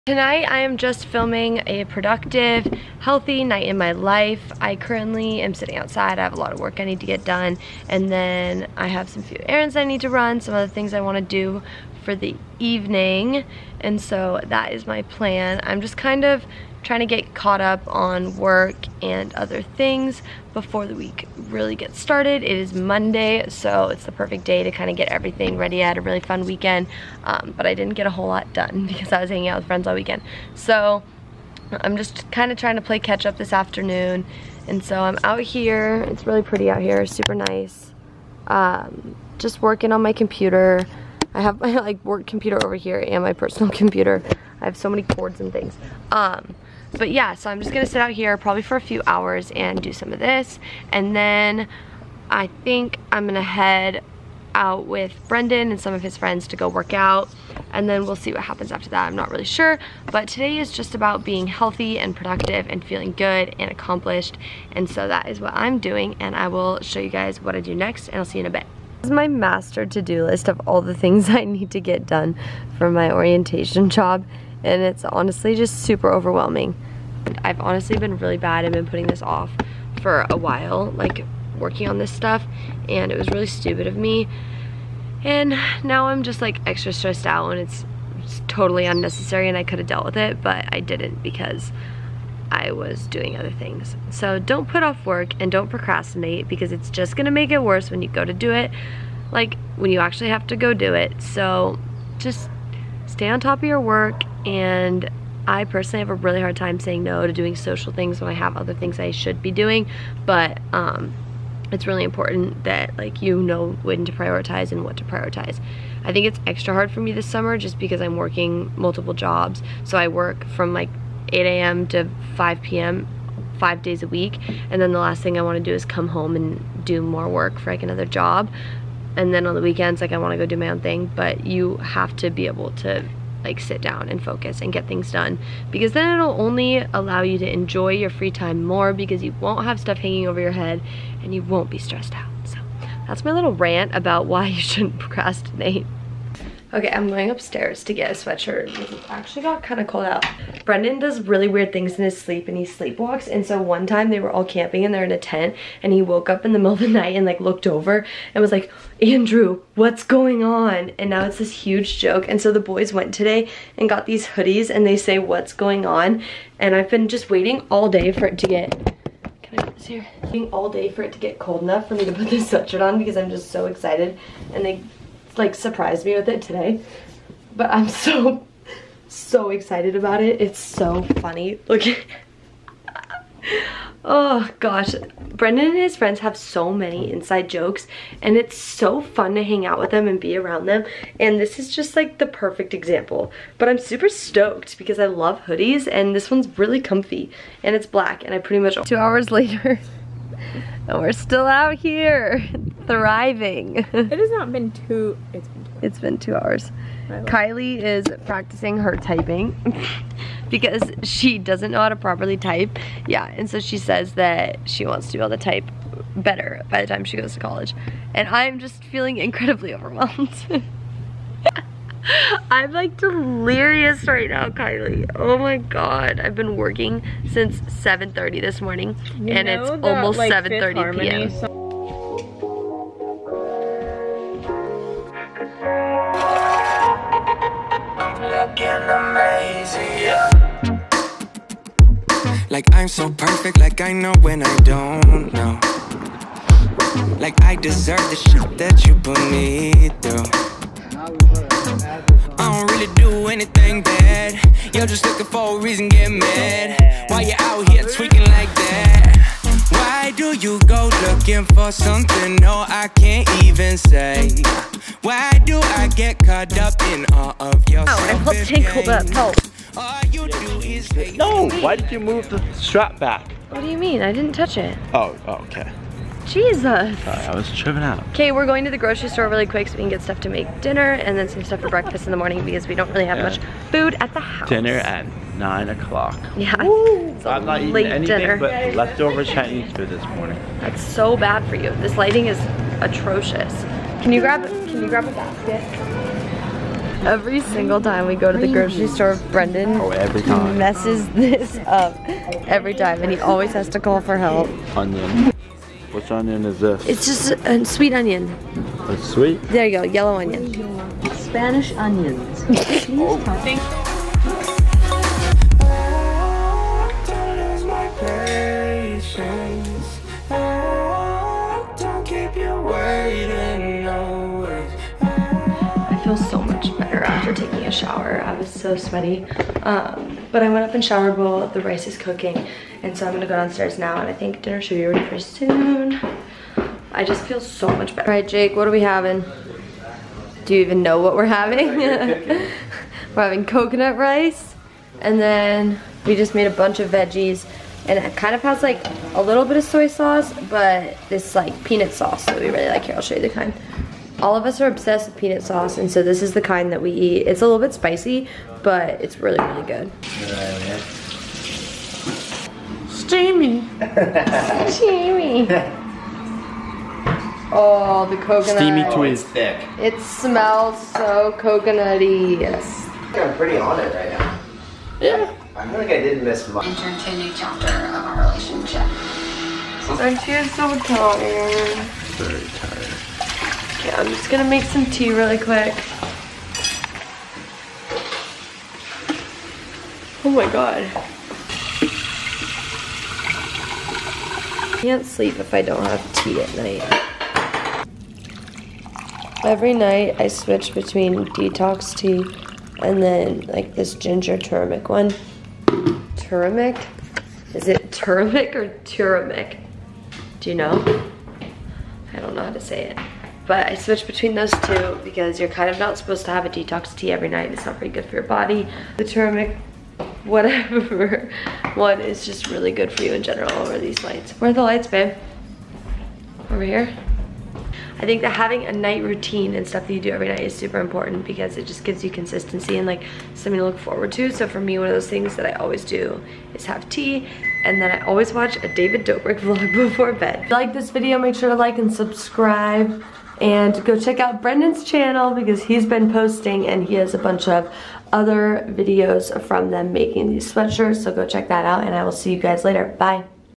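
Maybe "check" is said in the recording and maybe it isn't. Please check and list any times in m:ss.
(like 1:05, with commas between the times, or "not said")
7:23, 7:31.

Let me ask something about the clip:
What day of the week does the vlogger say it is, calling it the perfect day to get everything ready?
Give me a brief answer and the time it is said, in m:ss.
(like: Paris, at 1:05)
Monday, at 0:22.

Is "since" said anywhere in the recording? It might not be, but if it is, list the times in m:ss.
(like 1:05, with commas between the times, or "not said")
3:47.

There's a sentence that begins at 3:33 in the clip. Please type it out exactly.
Yeah, and so she says that she wants to be able to type better by the time she goes to college.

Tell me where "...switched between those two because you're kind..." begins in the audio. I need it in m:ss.
6:53.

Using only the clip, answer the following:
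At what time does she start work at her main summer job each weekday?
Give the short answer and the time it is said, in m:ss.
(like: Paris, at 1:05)
8 a.m., at 2:01.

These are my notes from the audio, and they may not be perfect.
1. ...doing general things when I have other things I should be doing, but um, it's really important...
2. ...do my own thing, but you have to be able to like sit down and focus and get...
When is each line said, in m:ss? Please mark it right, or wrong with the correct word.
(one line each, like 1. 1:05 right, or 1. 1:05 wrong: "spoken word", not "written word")
1. 1:47 wrong: "social", not "general"
2. 2:10 right.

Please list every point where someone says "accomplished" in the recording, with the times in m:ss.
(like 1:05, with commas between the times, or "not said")
1:03.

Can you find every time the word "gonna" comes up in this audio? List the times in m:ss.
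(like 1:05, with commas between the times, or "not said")
0:47, 0:53, 1:37, 5:33, 6:24.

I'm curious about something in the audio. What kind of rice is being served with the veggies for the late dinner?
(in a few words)
Coconut rice.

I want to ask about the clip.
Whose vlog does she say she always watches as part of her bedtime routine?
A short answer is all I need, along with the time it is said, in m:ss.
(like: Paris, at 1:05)
David Dobrik, at 7:18.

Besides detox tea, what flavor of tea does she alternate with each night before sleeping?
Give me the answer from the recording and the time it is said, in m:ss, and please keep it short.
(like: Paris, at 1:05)
Ginger turmeric, at 6:43.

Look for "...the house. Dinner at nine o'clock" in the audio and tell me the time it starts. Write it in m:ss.
4:44.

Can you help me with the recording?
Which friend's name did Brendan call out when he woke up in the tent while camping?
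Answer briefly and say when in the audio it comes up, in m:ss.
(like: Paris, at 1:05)
Andrew, at 2:39.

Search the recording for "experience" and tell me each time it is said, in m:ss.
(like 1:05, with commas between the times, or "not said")
not said.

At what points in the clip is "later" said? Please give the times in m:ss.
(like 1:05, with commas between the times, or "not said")
3:19, 7:32.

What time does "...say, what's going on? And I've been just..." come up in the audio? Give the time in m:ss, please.
2:44.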